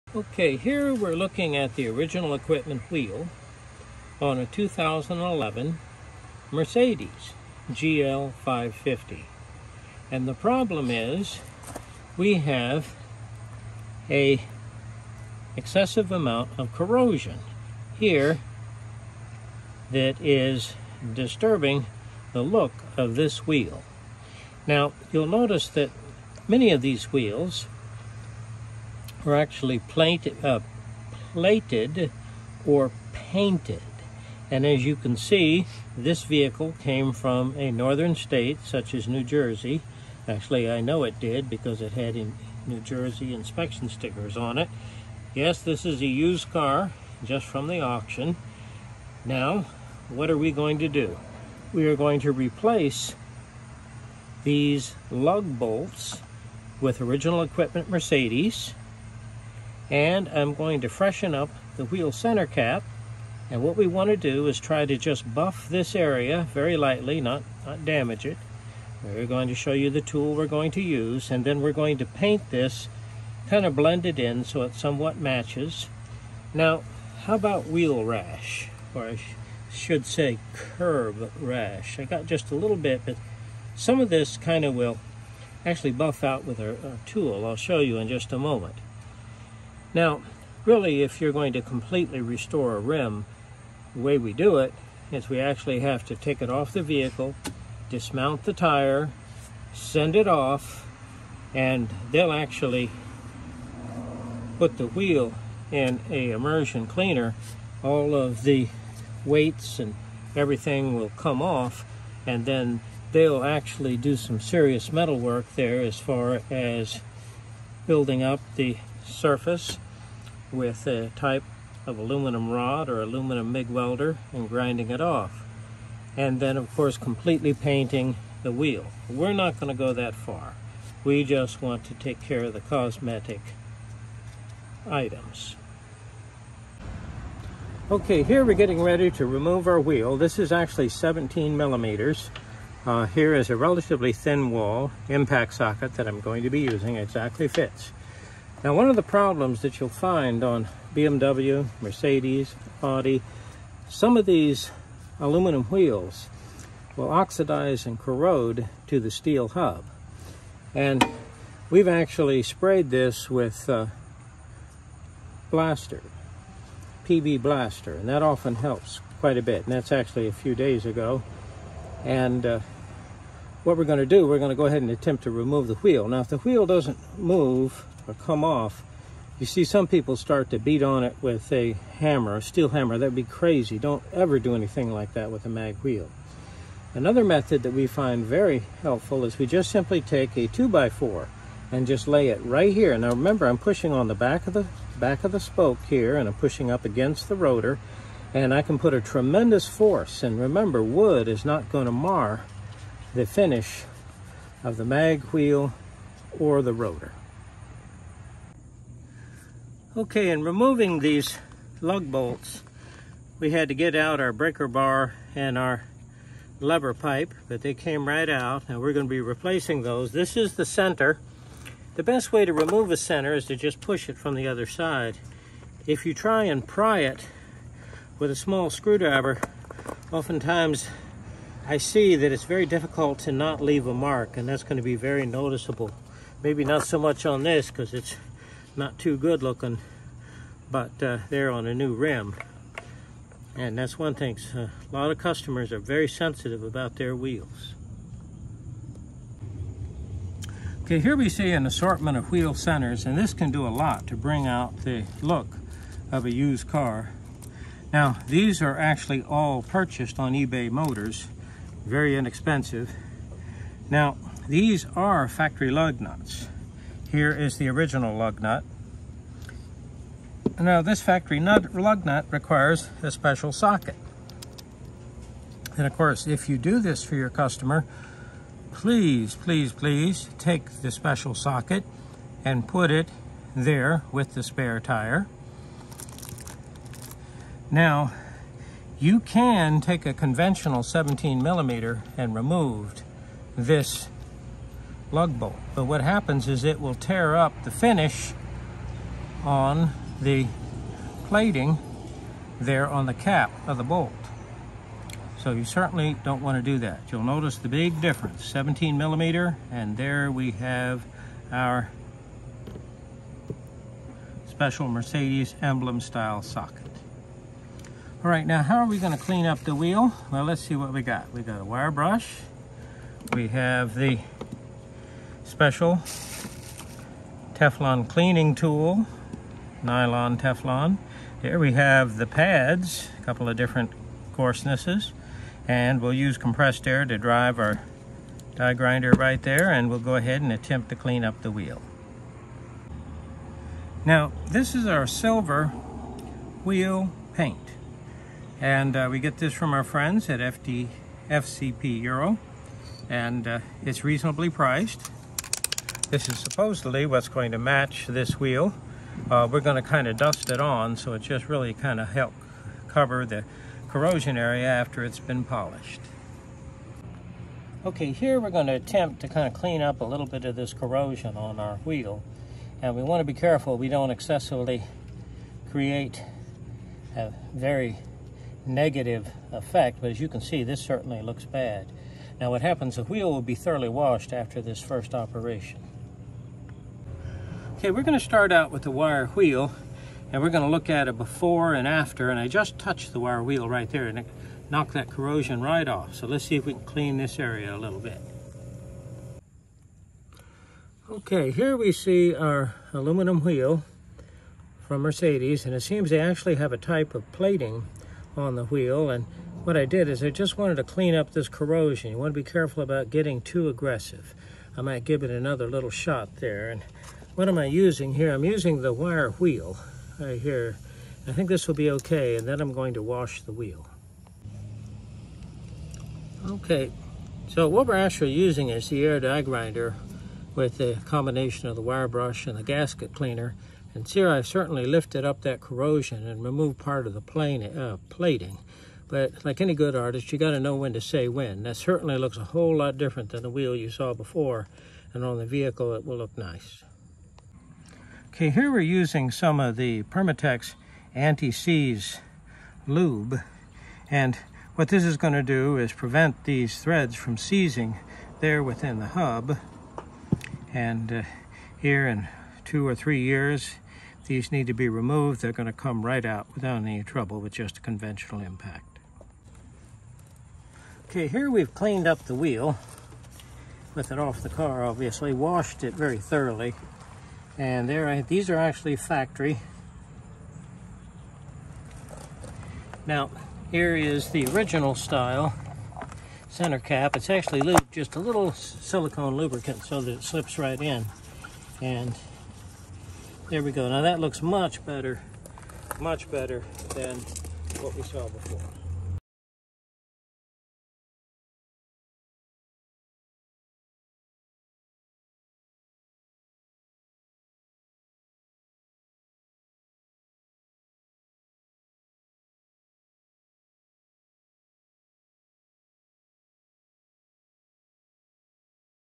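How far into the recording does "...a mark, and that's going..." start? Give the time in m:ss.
3:53.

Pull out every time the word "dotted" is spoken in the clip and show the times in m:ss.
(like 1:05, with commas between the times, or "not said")
not said.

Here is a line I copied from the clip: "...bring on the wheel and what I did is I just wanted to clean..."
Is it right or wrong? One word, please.
wrong.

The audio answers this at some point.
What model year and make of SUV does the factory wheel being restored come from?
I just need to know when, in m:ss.
0:04.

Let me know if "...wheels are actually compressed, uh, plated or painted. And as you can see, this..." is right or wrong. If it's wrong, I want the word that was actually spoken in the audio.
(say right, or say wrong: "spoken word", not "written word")
wrong: "plated", not "compressed".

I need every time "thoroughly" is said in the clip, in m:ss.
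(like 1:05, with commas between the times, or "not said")
6:23, 7:56.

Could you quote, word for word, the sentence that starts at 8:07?
It's actually lubed just a little silicone lubricant so that it slips right in.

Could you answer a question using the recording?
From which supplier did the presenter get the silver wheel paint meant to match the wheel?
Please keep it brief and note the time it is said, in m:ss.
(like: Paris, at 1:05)
FCP Euro, at 5:51.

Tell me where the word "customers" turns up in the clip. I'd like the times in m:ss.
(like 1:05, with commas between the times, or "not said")
4:05, 4:37.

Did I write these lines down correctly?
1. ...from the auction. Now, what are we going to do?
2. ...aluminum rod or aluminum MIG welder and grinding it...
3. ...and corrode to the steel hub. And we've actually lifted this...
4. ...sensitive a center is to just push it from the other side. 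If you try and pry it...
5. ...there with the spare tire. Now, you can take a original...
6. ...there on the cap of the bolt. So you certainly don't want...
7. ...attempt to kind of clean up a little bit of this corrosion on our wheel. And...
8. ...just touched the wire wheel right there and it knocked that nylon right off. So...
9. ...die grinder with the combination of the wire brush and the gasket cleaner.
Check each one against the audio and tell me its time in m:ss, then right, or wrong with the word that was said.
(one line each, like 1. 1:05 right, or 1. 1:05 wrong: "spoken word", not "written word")
1. 0:47 right
2. 2:01 right
3. 2:37 wrong: "sprayed", not "lifted"
4. 3:42 wrong: "remove", not "sensitive"
5. 4:43 wrong: "conventional", not "original"
6. 5:02 right
7. 6:08 right
8. 6:32 wrong: "corrosion", not "nylon"
9. 7:09 right.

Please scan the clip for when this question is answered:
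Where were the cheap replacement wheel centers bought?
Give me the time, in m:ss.
4:20.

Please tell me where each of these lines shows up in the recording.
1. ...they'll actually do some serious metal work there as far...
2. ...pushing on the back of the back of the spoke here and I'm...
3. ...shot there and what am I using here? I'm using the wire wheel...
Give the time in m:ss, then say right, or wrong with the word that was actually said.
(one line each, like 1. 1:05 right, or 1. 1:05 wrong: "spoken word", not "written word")
1. 1:53 right
2. 3:13 right
3. 6:55 right.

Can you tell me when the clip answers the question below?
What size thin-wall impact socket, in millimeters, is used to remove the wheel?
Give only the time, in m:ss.
2:20.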